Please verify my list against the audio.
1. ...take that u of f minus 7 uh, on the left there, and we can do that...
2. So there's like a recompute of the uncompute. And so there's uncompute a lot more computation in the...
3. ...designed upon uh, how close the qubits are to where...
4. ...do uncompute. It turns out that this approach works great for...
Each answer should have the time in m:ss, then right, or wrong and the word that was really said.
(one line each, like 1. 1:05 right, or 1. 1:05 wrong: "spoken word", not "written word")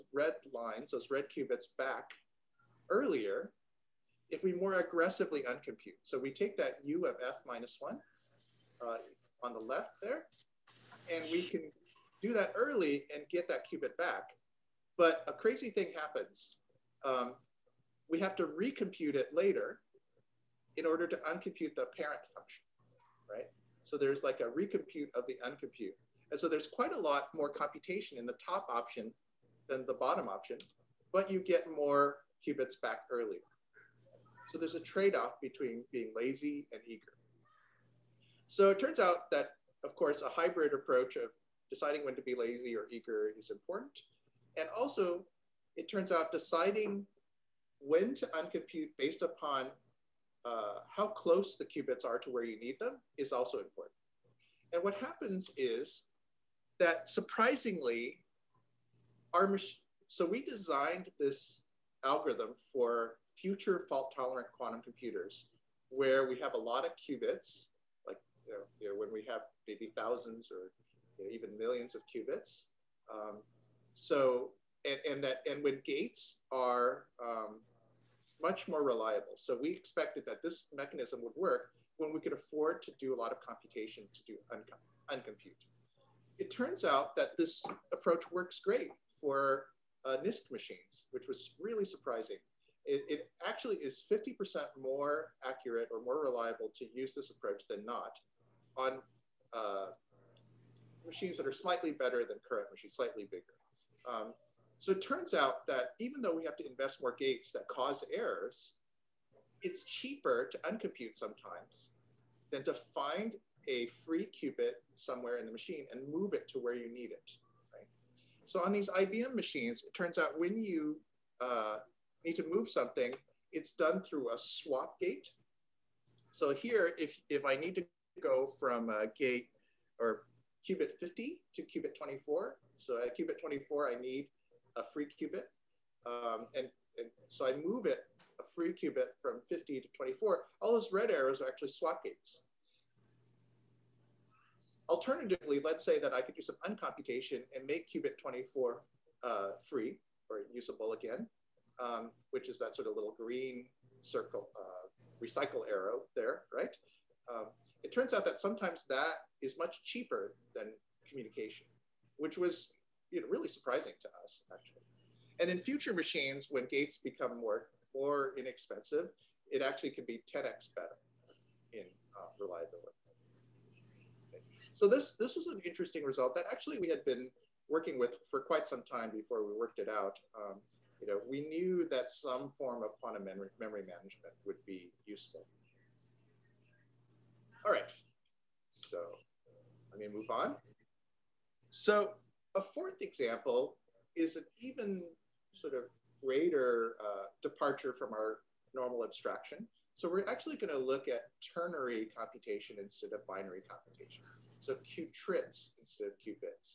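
1. 0:06 wrong: "1", not "7"
2. 0:23 wrong: "quite", not "uncompute"
3. 0:48 wrong: "based", not "designed"
4. 1:24 right.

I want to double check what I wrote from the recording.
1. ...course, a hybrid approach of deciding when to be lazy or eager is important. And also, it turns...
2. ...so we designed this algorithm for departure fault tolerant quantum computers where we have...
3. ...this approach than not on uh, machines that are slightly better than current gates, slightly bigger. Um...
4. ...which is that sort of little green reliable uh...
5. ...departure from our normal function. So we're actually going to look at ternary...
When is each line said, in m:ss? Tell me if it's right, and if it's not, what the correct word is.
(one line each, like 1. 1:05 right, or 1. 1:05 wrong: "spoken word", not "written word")
1. 0:39 right
2. 1:00 wrong: "future", not "departure"
3. 1:37 wrong: "machines", not "gates"
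4. 2:32 wrong: "circle", not "reliable"
5. 3:17 wrong: "abstraction", not "function".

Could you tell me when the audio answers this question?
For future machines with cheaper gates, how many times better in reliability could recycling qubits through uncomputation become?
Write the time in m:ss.
2:50.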